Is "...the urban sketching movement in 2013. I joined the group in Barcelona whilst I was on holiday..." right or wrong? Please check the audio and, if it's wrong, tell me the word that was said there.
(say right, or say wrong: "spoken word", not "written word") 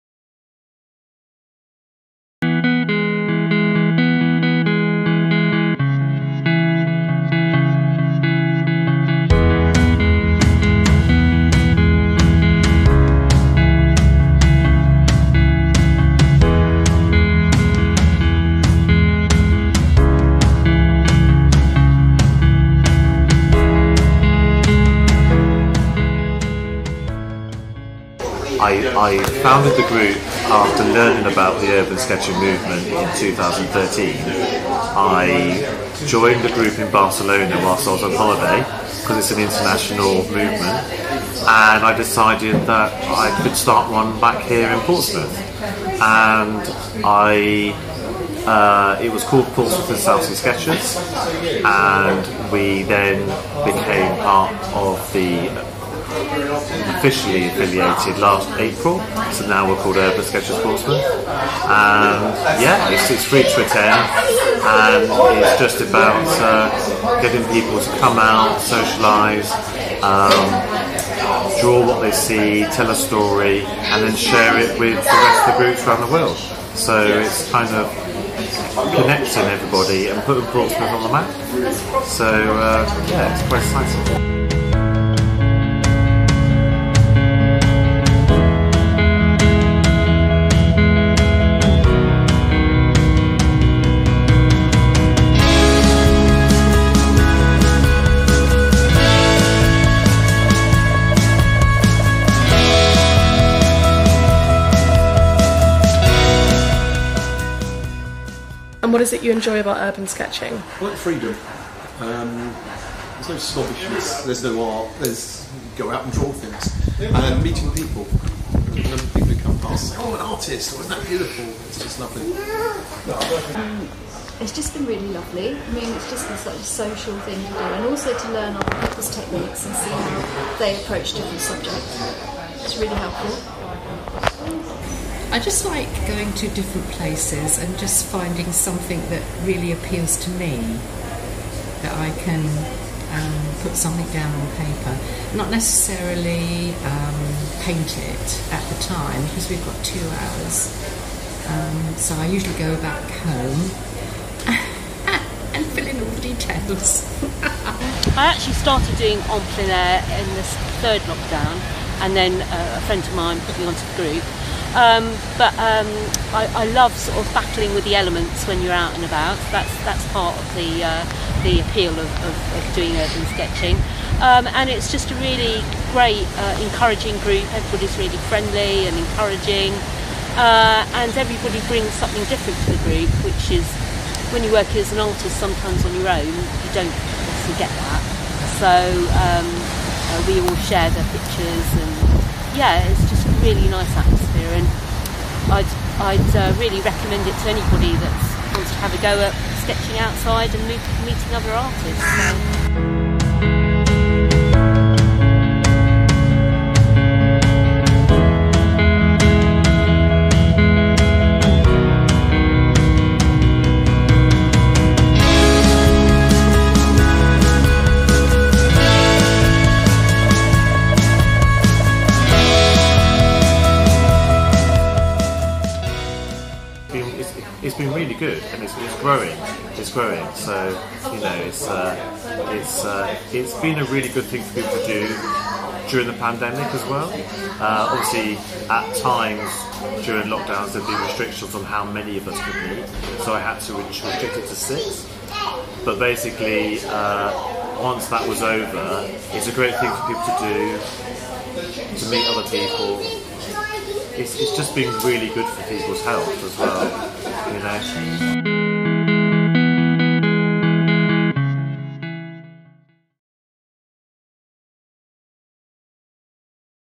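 right.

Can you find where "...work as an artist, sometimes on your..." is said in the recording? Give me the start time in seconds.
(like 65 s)
184 s.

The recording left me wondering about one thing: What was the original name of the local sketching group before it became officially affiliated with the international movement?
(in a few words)
Portsmouth and Southsea Sketchers.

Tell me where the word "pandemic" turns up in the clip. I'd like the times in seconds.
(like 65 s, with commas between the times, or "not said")
236 s.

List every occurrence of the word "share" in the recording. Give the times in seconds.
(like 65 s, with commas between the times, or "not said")
74 s, 190 s.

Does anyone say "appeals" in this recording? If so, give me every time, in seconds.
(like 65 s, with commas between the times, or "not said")
139 s, 171 s.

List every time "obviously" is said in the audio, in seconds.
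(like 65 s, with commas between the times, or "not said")
187 s, 237 s.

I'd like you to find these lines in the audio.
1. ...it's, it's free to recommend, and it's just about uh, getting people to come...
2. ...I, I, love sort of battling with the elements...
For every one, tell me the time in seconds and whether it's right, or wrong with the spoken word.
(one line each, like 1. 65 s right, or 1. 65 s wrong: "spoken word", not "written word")
1. 62 s wrong: "attend", not "recommend"
2. 166 s right.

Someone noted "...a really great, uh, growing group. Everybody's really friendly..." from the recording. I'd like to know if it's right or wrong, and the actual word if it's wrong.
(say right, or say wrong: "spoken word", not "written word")
wrong: "encouraging", not "growing".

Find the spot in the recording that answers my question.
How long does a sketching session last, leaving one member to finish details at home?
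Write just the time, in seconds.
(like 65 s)
149 s.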